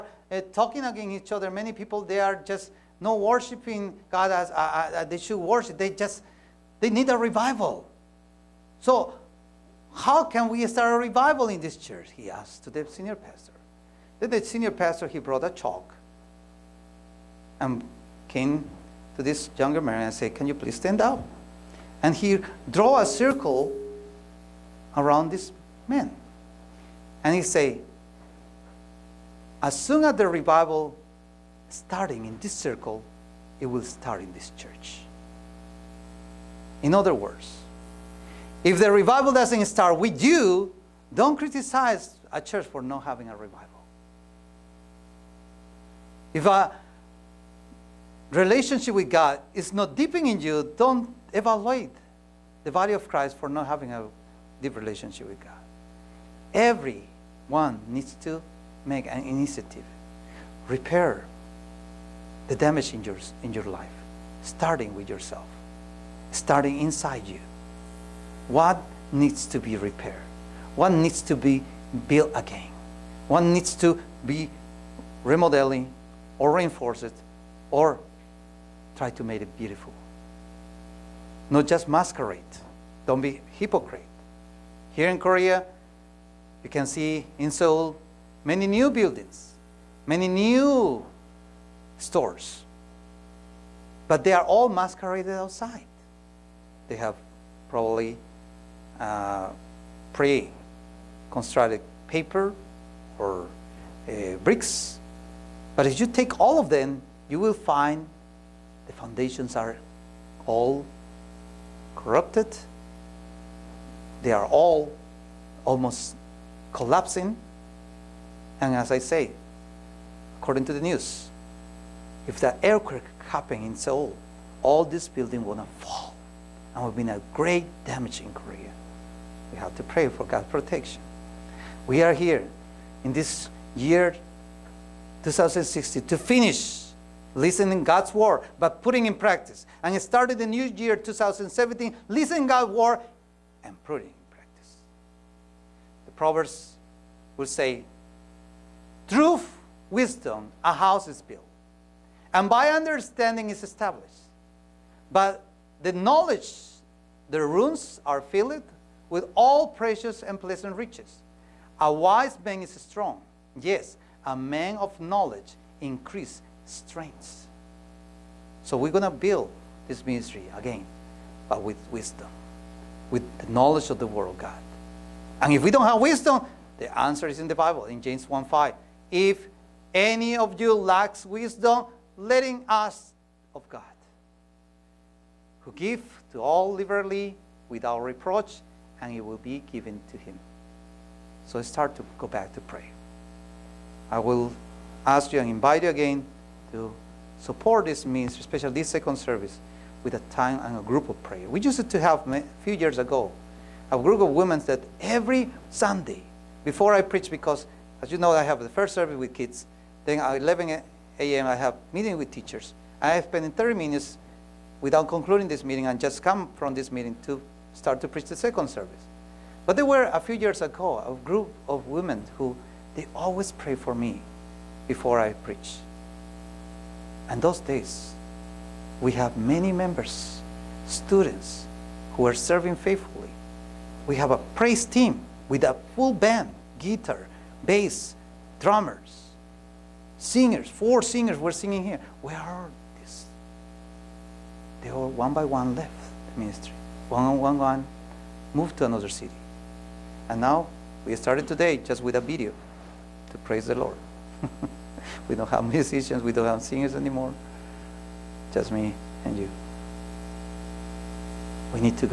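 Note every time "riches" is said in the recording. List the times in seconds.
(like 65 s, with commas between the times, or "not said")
160 s.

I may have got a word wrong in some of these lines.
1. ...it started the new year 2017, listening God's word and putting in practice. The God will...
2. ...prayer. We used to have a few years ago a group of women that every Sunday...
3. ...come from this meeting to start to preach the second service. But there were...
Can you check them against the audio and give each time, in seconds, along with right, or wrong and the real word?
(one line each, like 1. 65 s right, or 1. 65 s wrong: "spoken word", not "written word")
1. 139 s wrong: "Proverbs", not "God"
2. 201 s right
3. 216 s right.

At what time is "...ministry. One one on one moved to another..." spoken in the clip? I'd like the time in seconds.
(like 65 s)
246 s.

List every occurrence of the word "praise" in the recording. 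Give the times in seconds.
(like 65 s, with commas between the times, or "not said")
234 s, 253 s.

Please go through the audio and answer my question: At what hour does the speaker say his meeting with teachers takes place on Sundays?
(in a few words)
11 a.m.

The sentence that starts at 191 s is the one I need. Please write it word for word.
So start to go back to prayer.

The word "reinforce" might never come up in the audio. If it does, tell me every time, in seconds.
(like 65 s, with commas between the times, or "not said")
76 s.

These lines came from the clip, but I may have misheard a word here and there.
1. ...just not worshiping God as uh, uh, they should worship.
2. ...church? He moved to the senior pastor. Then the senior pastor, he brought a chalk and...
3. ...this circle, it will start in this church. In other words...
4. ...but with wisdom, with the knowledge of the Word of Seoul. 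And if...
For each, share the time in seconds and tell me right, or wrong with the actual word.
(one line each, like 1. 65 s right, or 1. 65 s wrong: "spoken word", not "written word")
1. 2 s right
2. 11 s wrong: "asked", not "moved"
3. 32 s right
4. 171 s wrong: "God", not "Seoul".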